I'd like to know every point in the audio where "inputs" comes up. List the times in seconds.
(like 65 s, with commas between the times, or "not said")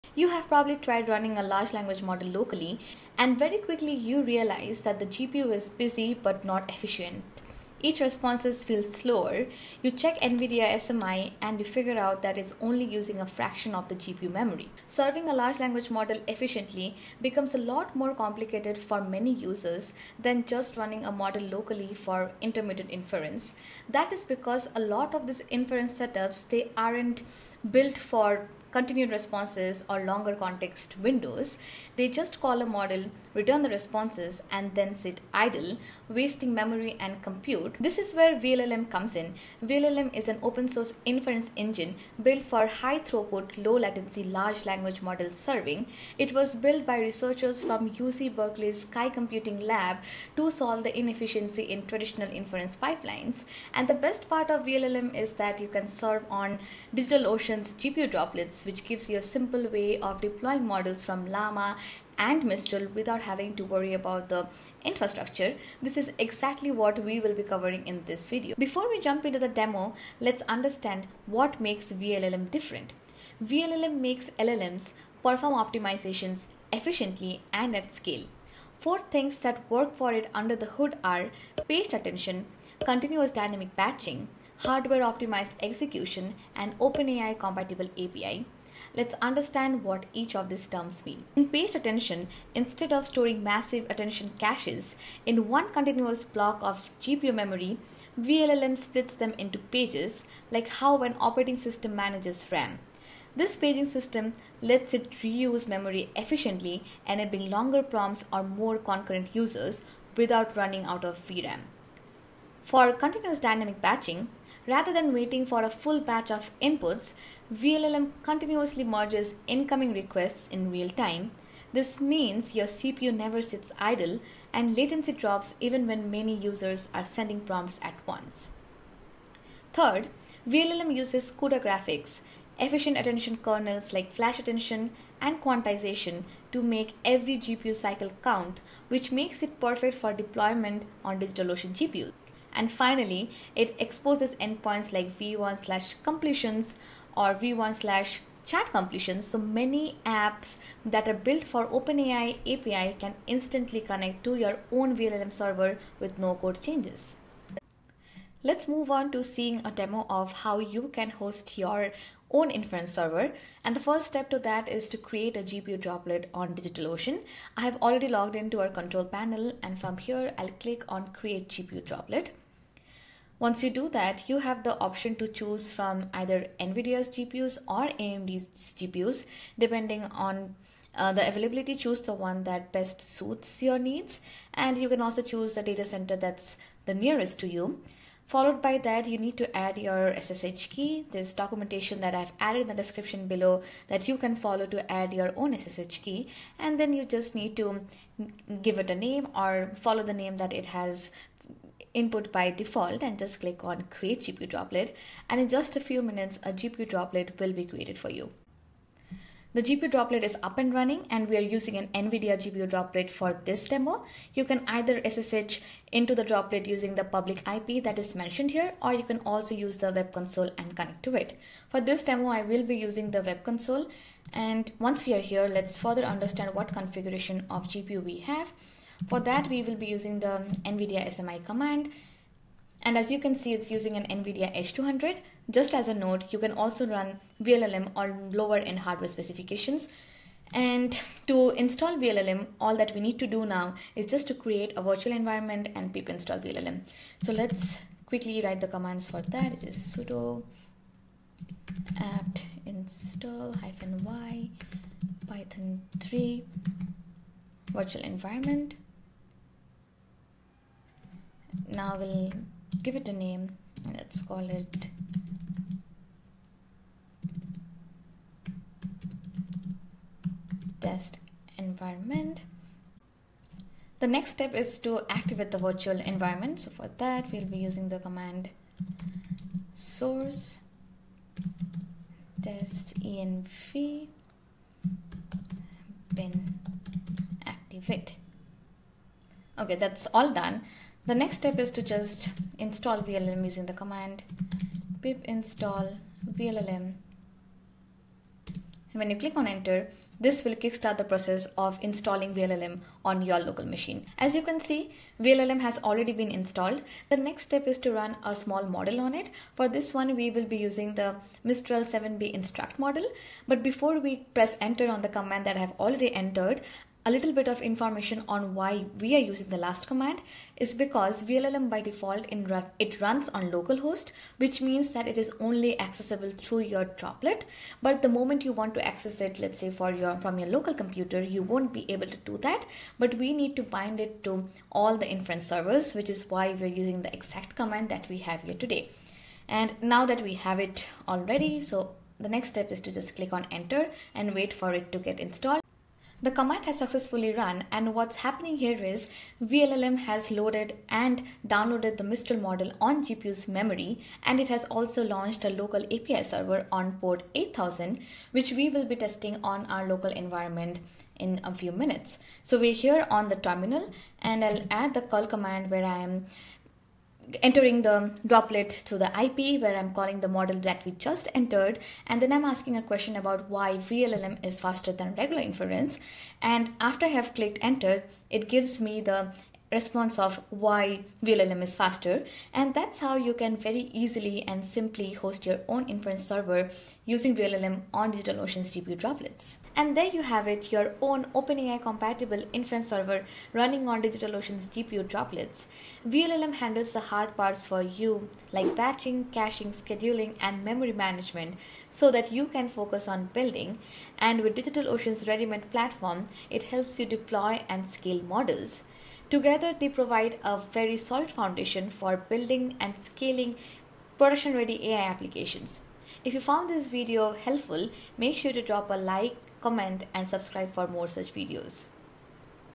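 116 s, 201 s.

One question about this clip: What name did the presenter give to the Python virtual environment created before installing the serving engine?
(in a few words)
test environment.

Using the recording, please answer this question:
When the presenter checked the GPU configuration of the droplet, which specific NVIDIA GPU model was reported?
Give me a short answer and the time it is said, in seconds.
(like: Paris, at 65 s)
NVIDIA H200, at 234 s.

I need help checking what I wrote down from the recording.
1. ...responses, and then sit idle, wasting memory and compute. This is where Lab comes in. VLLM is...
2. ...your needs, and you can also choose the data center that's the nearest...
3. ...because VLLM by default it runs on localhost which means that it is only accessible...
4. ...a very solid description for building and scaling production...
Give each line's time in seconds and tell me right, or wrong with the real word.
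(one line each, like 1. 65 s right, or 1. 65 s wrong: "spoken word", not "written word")
1. 33 s wrong: "VLLM", not "Lab"
2. 183 s right
3. 320 s right
4. 410 s wrong: "foundation", not "description".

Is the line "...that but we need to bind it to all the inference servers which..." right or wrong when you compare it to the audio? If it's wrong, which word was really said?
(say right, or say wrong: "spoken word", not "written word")
right.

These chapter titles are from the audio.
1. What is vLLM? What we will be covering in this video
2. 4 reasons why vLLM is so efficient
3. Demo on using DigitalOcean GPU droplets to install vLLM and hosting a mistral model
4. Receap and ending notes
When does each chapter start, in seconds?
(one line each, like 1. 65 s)
1. 44 s
2. 74 s
3. 164 s
4. 395 s.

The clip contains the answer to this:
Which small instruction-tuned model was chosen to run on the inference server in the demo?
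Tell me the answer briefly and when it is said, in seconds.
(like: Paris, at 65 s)
Mistral 7B instruct, at 311 s.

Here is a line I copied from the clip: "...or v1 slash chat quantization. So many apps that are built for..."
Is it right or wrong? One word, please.
wrong.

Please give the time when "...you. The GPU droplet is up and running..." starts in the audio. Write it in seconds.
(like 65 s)
208 s.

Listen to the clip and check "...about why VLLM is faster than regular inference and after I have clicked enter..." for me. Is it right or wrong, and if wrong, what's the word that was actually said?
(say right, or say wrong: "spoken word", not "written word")
right.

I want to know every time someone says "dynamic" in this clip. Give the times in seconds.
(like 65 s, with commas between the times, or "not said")
83 s, 113 s.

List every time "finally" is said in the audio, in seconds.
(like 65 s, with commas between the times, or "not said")
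142 s.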